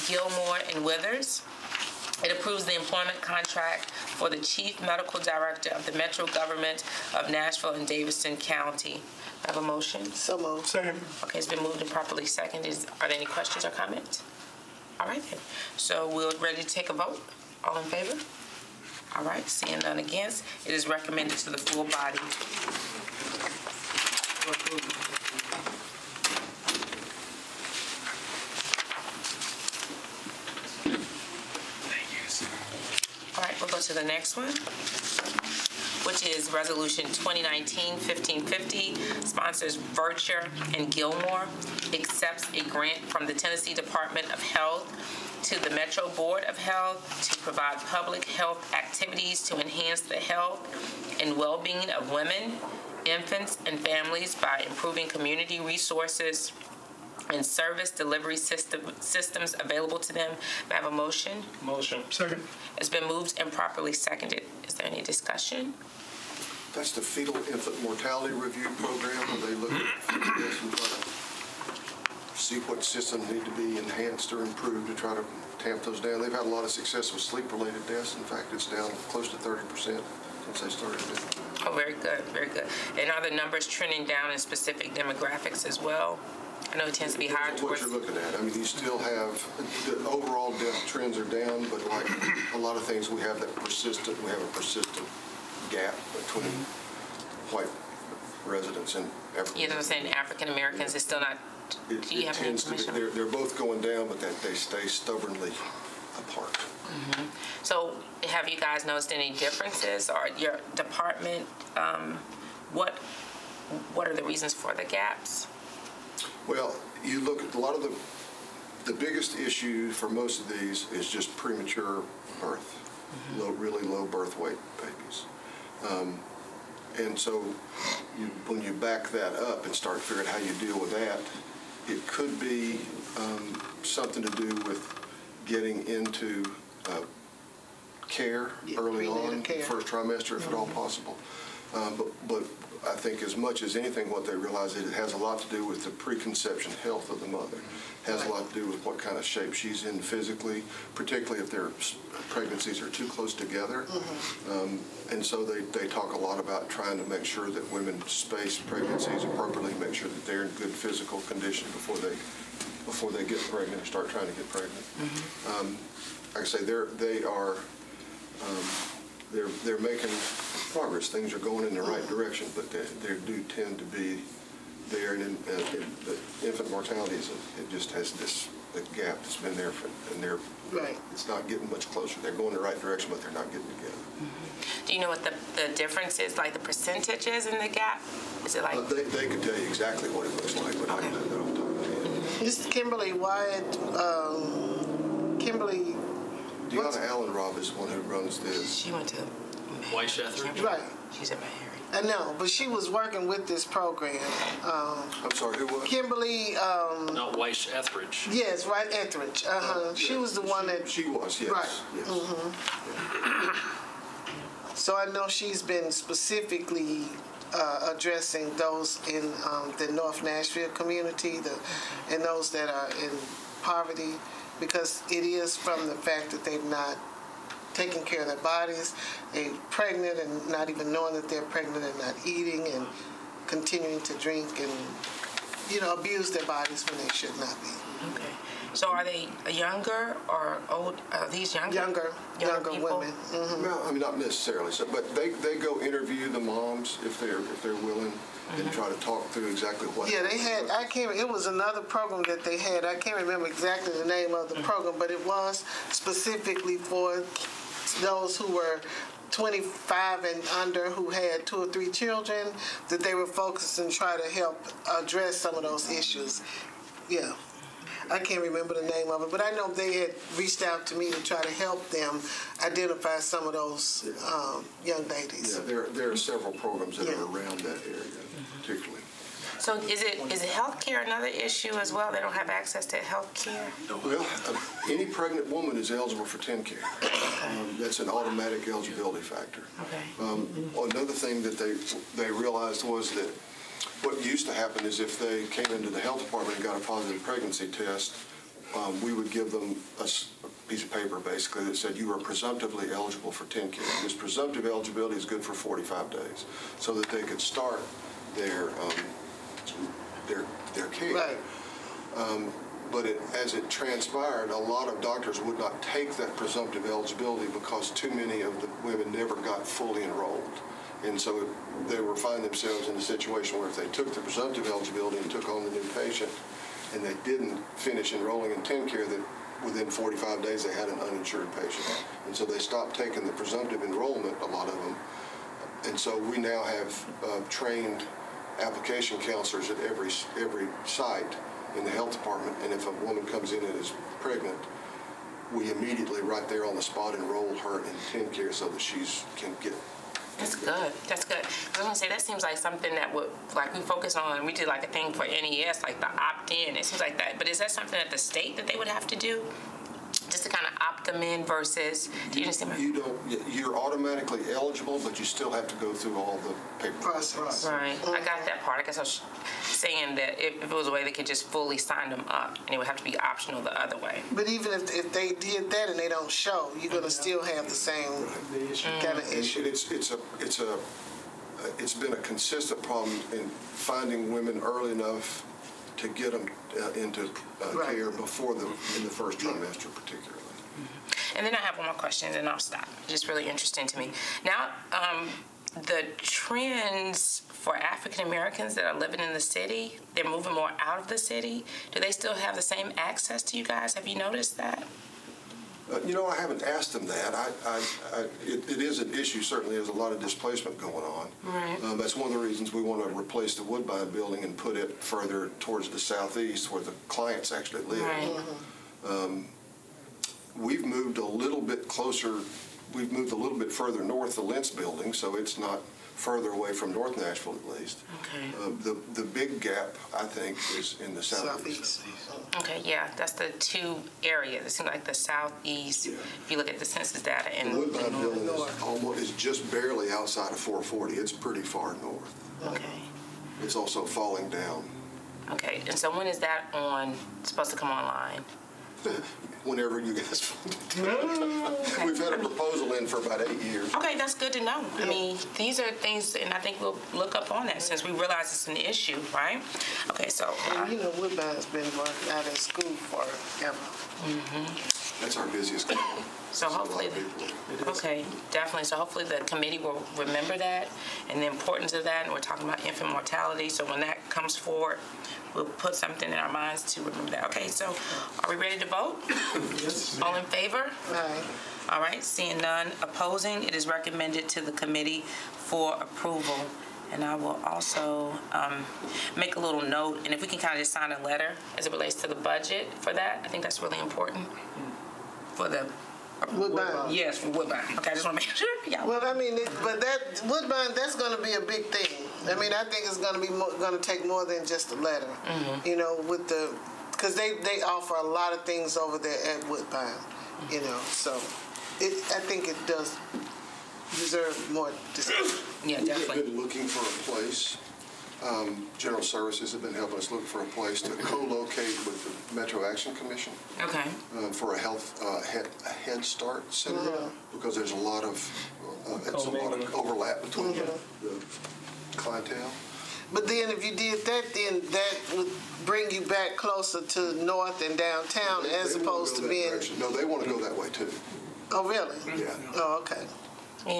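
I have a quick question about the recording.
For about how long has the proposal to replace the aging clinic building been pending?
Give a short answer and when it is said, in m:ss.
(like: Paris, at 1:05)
8 years, at 7:33.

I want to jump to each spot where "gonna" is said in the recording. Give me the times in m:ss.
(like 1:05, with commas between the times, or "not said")
5:51, 6:16.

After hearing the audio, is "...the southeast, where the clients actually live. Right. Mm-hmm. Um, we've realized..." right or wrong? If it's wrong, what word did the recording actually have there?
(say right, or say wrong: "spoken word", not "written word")
wrong: "moved", not "realized".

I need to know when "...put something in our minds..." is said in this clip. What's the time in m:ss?
7:55.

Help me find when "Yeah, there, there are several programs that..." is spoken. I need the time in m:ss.
4:35.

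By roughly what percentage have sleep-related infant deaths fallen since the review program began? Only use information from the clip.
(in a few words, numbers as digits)
30%.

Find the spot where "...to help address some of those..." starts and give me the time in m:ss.
4:24.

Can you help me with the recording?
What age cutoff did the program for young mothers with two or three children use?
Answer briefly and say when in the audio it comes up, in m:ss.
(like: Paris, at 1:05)
25 and under, at 4:19.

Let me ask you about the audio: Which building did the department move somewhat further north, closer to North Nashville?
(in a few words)
Lentz building.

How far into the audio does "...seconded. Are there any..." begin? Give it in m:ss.
0:12.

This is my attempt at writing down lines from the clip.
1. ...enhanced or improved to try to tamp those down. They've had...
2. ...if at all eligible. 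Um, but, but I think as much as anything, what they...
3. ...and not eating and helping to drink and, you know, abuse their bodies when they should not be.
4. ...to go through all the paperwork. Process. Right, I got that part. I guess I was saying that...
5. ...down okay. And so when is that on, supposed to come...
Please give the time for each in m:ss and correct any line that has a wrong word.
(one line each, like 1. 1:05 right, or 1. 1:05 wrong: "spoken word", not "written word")
1. 1:13 right
2. 2:20 wrong: "possible", not "eligible"
3. 3:51 wrong: "continuing", not "helping"
4. 6:05 right
5. 7:24 right.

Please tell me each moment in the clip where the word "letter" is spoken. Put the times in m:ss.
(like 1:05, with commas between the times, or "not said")
8:11, 8:24.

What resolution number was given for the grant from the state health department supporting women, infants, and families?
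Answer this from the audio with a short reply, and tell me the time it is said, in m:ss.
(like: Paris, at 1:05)
2019-1550, at 0:37.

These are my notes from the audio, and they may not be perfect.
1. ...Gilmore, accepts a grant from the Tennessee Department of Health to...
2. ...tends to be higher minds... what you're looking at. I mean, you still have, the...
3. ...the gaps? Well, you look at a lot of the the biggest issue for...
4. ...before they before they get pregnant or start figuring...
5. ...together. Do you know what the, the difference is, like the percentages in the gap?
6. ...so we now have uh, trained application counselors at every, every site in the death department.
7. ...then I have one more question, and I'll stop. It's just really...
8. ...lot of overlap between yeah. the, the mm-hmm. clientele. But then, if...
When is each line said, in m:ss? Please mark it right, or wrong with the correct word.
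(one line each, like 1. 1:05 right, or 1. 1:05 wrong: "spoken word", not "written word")
1. 0:40 right
2. 1:26 wrong: "towards", not "minds"
3. 1:54 right
4. 2:41 wrong: "trying", not "figuring"
5. 3:03 right
6. 5:35 wrong: "health", not "death"
7. 6:31 right
8. 8:49 right.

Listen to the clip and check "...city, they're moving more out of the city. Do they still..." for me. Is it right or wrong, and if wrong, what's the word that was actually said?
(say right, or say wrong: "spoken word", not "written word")
right.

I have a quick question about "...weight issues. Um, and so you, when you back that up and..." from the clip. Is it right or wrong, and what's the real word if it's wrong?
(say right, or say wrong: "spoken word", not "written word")
wrong: "babies", not "issues".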